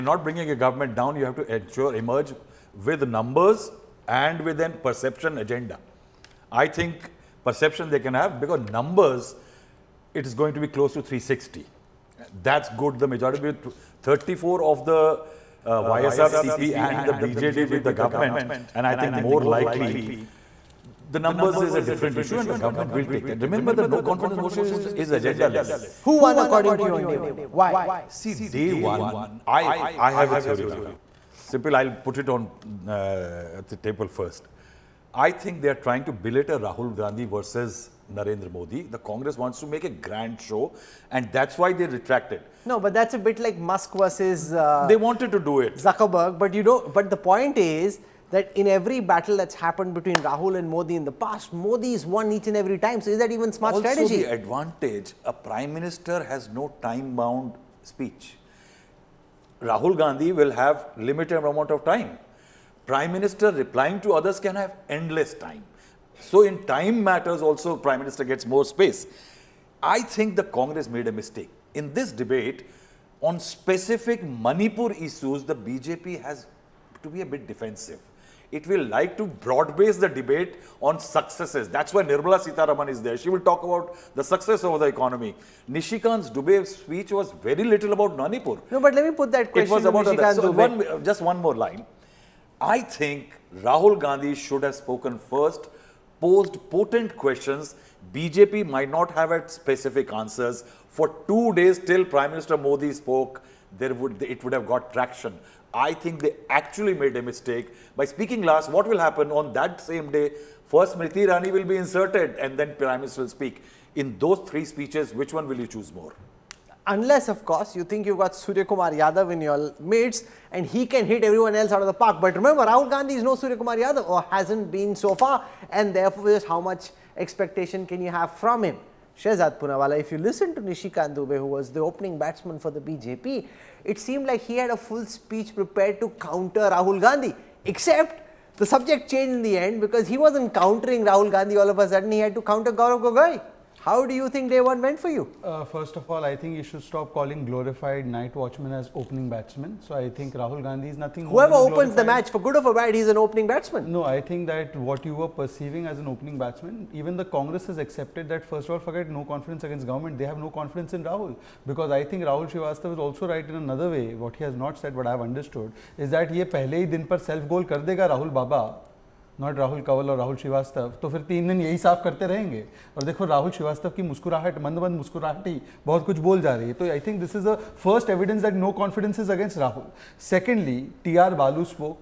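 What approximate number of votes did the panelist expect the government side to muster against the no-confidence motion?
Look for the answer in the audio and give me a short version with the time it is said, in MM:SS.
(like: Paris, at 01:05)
360, at 00:11.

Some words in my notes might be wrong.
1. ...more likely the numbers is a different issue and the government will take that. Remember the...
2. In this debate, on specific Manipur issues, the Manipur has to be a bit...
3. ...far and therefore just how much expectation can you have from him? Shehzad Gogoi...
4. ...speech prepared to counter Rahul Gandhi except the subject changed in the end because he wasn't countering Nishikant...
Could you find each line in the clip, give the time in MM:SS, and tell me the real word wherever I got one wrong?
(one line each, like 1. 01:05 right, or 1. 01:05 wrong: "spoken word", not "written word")
1. 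00:19 right
2. 01:11 wrong: "BJP", not "Manipur"
3. 02:05 wrong: "Poonawalla", not "Gogoi"
4. 02:15 wrong: "Rahul", not "Nishikant".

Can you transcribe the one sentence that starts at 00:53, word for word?
So is that even smart also strategy?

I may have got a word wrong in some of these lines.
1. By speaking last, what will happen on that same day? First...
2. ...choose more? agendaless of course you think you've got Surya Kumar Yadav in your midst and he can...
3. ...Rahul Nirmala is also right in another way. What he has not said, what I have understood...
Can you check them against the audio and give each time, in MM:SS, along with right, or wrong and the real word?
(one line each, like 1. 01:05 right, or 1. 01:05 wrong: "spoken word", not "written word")
1. 01:47 right
2. 01:55 wrong: "unless", not "agendaless"
3. 02:42 wrong: "Srivastav", not "Nirmala".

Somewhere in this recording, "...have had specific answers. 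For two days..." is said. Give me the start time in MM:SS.
01:39.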